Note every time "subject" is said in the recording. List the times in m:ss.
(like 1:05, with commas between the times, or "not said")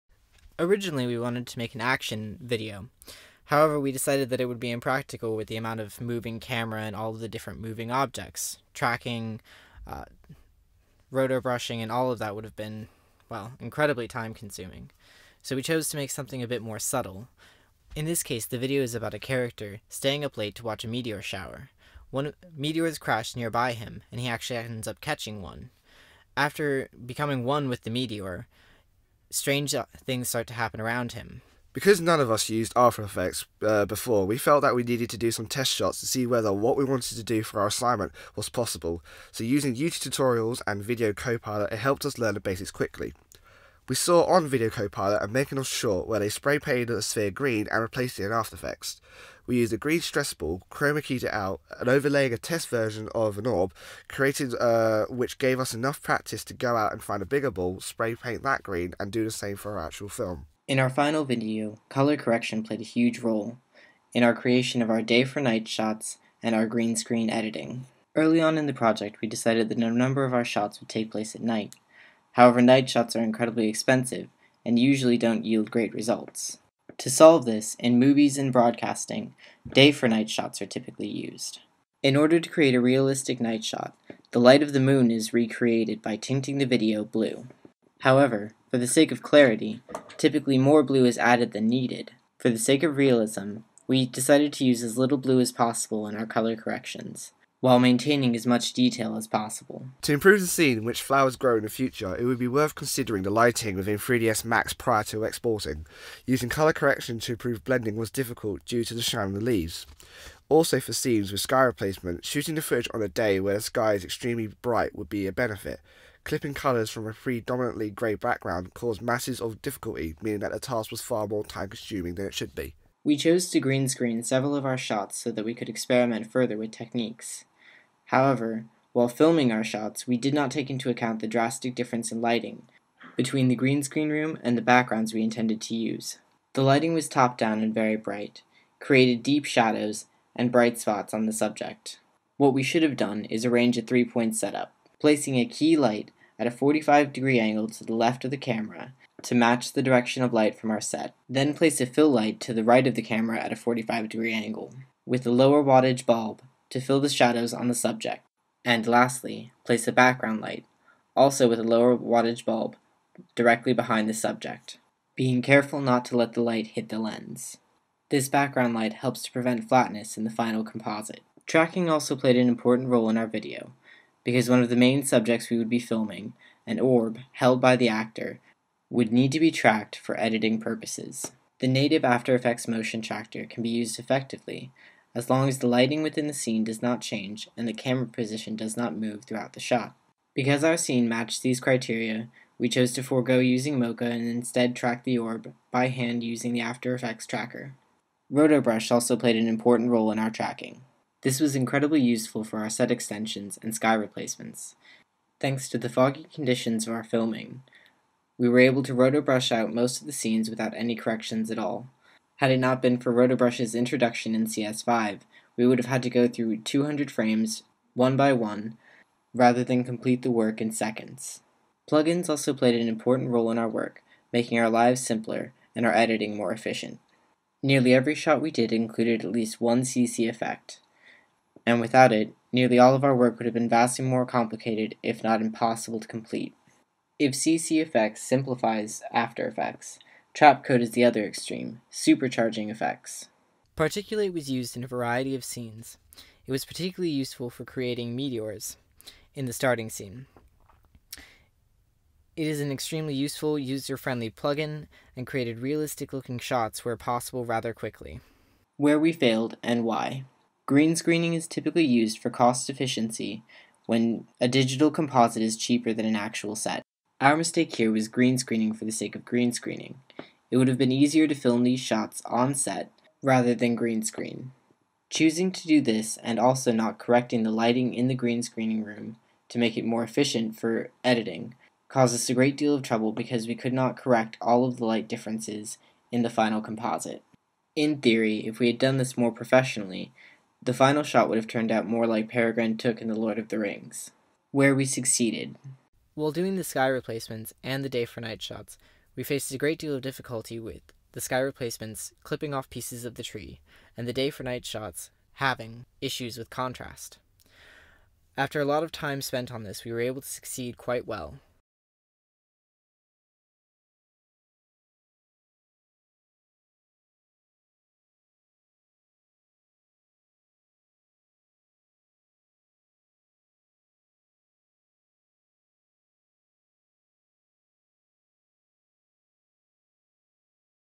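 2:21, 2:37, 2:44, 2:55.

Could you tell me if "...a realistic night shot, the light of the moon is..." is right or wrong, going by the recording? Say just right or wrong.
right.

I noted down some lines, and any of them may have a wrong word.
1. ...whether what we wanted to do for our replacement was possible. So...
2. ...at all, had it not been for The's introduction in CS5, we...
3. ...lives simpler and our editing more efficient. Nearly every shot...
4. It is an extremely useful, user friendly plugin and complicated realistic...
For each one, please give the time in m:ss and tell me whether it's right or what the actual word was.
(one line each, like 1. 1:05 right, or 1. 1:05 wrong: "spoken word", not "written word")
1. 0:36 wrong: "assignment", not "replacement"
2. 3:31 wrong: "Rotobrush", not "The"
3. 3:44 right
4. 4:12 wrong: "created", not "complicated".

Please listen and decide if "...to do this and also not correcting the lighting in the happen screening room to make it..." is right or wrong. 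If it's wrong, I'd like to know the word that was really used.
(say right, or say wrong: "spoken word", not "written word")
wrong: "green", not "happen".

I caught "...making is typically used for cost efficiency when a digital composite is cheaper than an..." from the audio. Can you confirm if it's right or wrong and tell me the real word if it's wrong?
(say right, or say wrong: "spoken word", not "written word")
wrong: "screening", not "making".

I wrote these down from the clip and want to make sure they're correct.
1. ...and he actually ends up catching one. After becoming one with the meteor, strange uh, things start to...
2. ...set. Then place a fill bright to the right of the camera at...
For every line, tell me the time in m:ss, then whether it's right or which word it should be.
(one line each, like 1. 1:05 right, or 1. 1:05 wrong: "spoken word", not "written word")
1. 0:24 right
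2. 2:30 wrong: "light", not "bright".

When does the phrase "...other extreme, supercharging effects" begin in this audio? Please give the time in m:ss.
4:01.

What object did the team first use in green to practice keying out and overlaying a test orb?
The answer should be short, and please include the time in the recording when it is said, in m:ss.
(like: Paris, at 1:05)
stress ball, at 0:49.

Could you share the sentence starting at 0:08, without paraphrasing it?
Tracking, uh, rotobrushing, and all of that would have been, well, incredibly time consuming.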